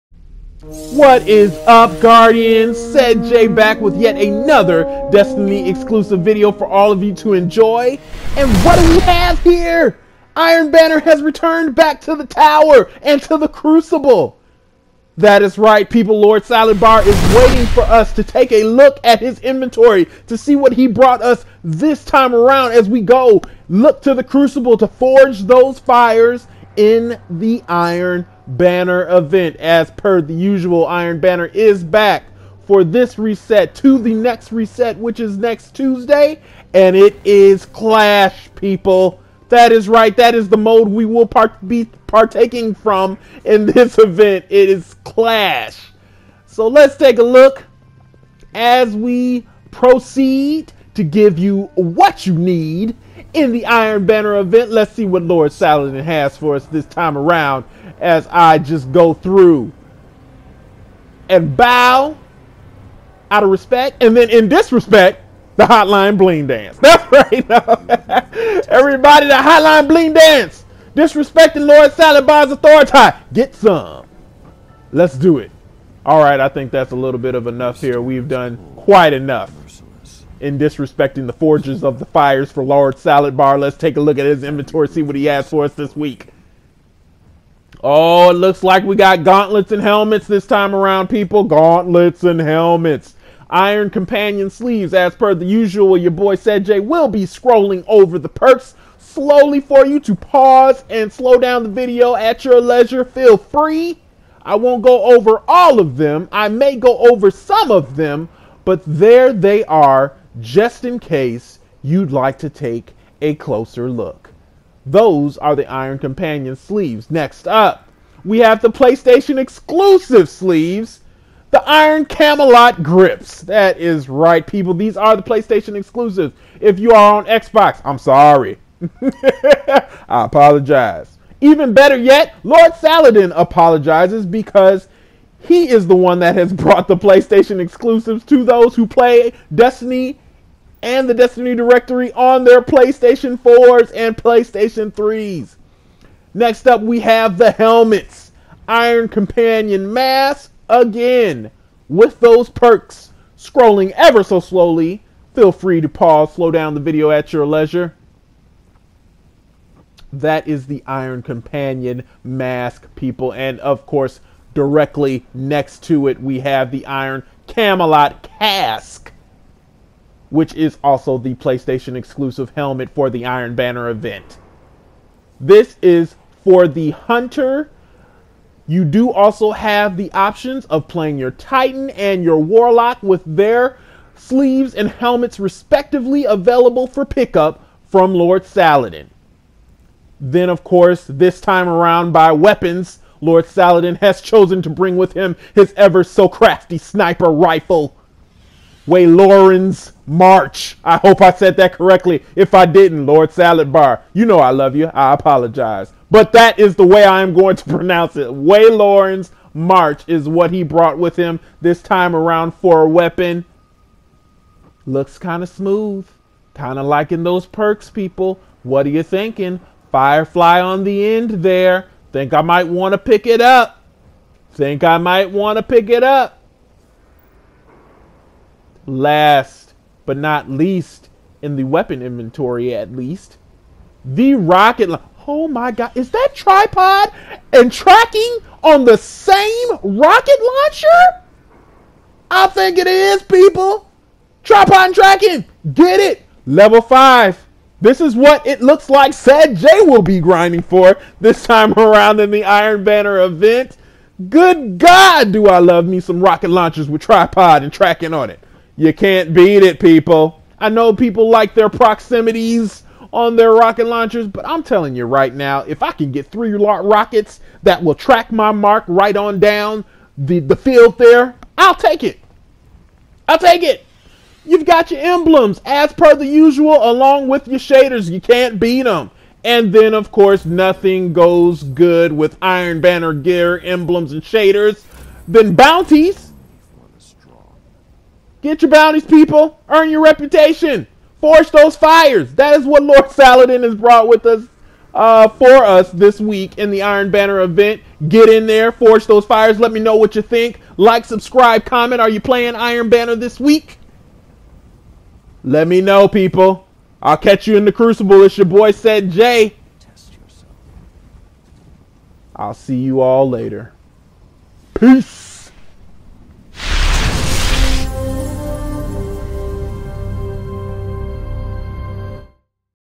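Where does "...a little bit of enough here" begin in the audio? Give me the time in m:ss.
1:16.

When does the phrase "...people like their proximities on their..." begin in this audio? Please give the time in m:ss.
4:20.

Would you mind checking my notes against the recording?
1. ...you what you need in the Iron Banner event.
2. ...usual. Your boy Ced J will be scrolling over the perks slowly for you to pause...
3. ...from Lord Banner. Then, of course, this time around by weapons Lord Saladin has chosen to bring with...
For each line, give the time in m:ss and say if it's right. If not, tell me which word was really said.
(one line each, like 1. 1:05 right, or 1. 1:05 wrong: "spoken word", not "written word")
1. 0:51 right
2. 1:35 right
3. 3:07 wrong: "Saladin", not "Banner".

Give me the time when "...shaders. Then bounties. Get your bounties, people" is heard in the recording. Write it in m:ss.
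4:44.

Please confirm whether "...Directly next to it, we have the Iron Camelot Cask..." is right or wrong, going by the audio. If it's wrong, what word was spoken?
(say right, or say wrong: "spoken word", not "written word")
right.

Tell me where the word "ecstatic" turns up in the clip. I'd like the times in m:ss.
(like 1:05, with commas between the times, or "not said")
not said.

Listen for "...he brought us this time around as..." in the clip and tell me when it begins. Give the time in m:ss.
0:20.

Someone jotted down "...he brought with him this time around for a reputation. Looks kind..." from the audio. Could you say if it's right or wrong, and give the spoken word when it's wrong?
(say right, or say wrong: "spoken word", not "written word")
wrong: "weapon", not "reputation".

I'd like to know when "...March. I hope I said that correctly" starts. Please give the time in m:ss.
3:20.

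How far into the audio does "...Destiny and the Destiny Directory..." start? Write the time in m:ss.
2:19.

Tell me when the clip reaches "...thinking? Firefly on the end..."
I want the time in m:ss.
3:39.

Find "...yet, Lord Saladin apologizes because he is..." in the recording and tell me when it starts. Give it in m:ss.
2:11.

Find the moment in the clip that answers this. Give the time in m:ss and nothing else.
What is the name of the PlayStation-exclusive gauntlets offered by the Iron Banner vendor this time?
2:01.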